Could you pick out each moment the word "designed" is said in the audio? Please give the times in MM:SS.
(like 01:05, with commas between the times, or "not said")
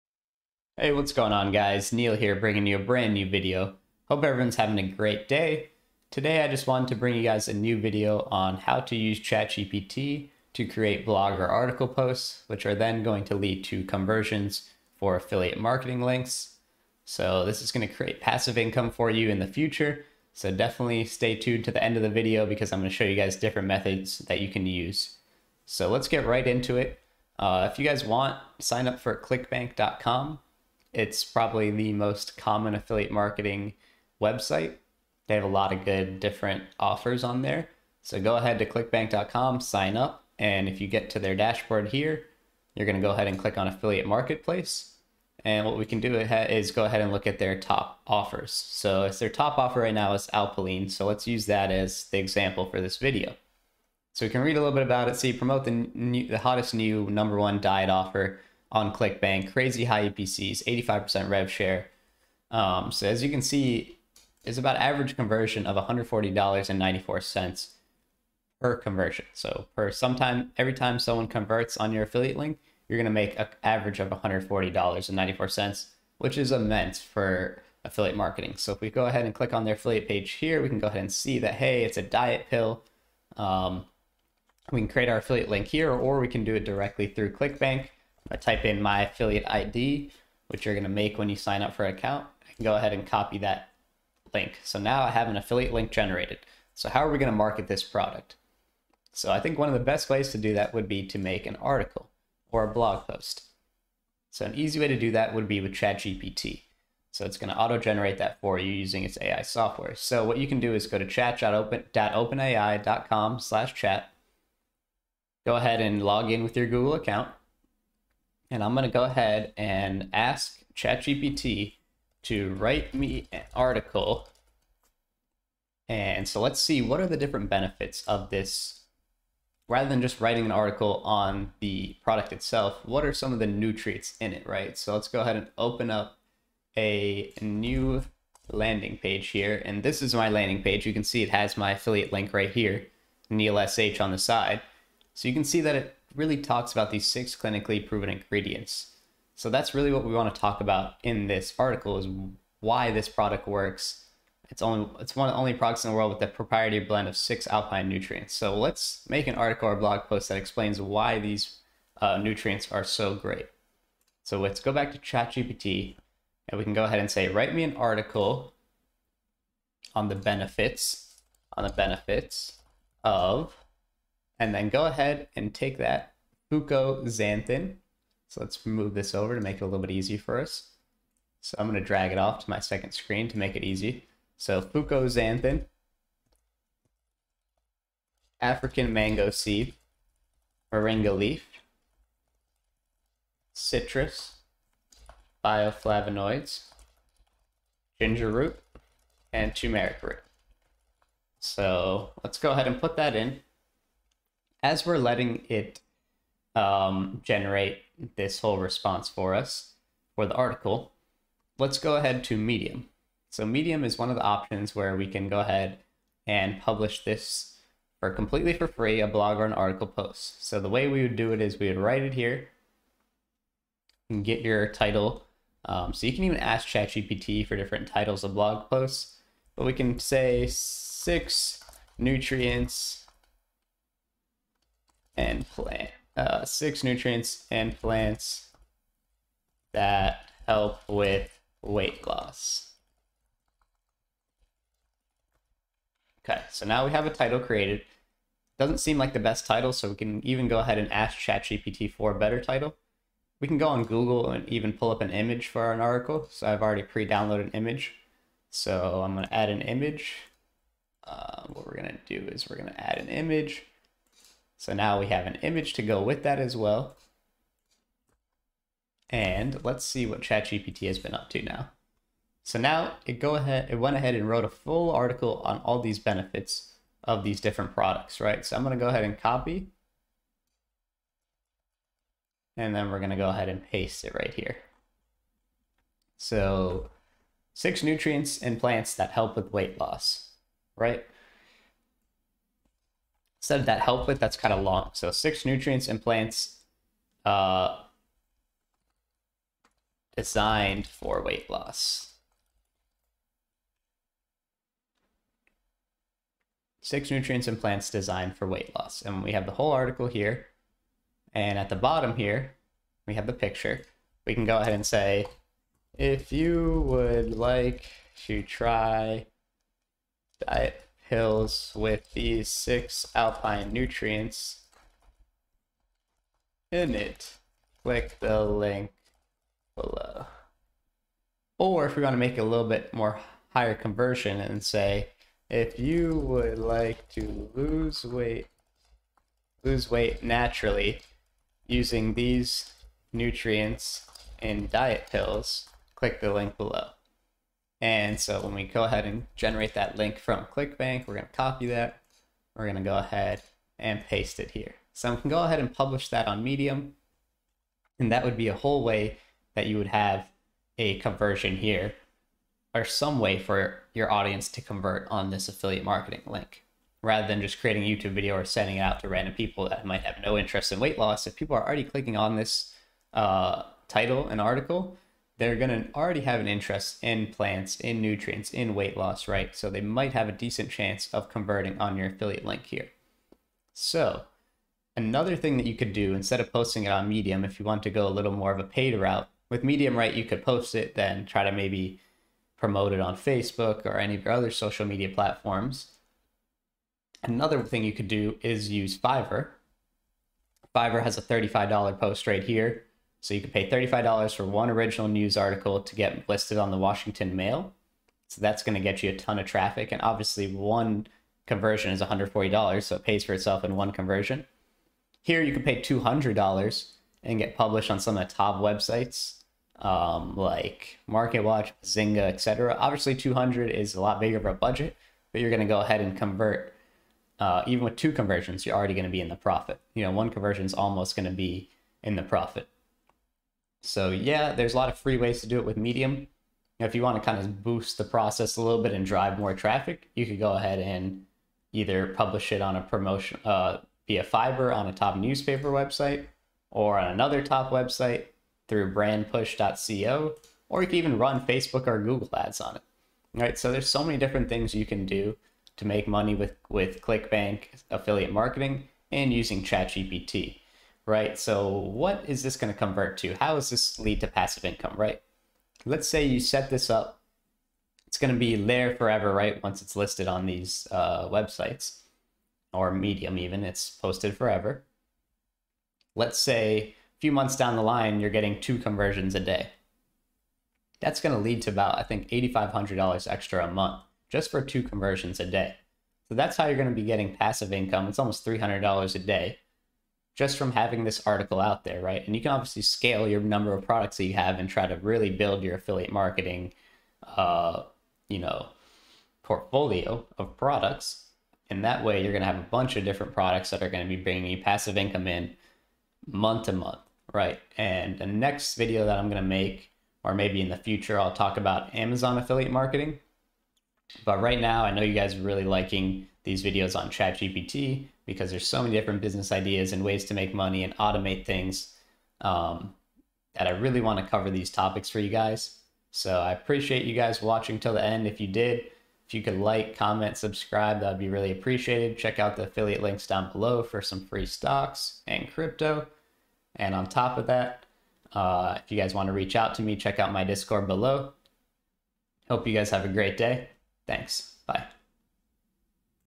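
05:00, 05:07.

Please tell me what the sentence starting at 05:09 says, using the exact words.
And we have the whole article here.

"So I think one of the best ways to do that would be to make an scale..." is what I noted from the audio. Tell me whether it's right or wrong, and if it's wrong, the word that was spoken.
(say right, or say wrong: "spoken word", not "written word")
wrong: "article", not "scale".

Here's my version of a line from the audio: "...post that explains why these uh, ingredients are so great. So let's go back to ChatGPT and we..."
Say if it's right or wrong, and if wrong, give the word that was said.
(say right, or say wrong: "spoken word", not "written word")
wrong: "nutrients", not "ingredients".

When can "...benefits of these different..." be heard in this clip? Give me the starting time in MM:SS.
04:35.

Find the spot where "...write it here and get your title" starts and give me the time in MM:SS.
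03:41.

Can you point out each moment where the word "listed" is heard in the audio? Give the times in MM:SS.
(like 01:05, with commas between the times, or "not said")
06:46, 07:49.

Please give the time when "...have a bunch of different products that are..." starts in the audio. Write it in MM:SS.
08:22.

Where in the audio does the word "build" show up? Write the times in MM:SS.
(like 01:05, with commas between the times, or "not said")
08:15.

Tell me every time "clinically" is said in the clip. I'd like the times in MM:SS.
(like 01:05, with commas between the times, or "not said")
02:27.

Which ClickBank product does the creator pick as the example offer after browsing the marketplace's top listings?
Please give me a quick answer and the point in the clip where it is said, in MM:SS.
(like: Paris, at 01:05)
Alpilean, at 00:50.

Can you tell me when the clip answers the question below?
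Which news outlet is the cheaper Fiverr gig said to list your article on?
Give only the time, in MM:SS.
06:46.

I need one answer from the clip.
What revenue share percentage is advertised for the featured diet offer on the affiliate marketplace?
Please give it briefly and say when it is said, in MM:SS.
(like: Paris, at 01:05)
85%, at 01:00.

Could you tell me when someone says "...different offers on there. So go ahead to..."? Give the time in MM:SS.
00:36.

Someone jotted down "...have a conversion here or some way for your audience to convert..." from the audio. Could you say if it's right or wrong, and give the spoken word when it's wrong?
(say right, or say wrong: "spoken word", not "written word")
right.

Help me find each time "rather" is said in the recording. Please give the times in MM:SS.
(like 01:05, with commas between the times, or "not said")
02:09, 06:07.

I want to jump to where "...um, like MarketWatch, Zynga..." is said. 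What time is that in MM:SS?
06:59.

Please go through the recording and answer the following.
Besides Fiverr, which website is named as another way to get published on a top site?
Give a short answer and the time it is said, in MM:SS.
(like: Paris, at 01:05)
brandpush.co, at 07:28.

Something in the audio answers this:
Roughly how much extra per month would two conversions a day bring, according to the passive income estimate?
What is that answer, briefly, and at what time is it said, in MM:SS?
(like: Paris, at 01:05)
$8,500, at 08:02.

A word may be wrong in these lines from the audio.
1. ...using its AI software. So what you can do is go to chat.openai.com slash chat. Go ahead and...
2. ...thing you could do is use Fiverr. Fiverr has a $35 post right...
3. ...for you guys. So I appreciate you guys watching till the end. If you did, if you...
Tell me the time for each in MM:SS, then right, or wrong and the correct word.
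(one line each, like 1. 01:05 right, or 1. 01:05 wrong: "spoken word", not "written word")
1. 01:48 right
2. 06:37 right
3. 08:45 right.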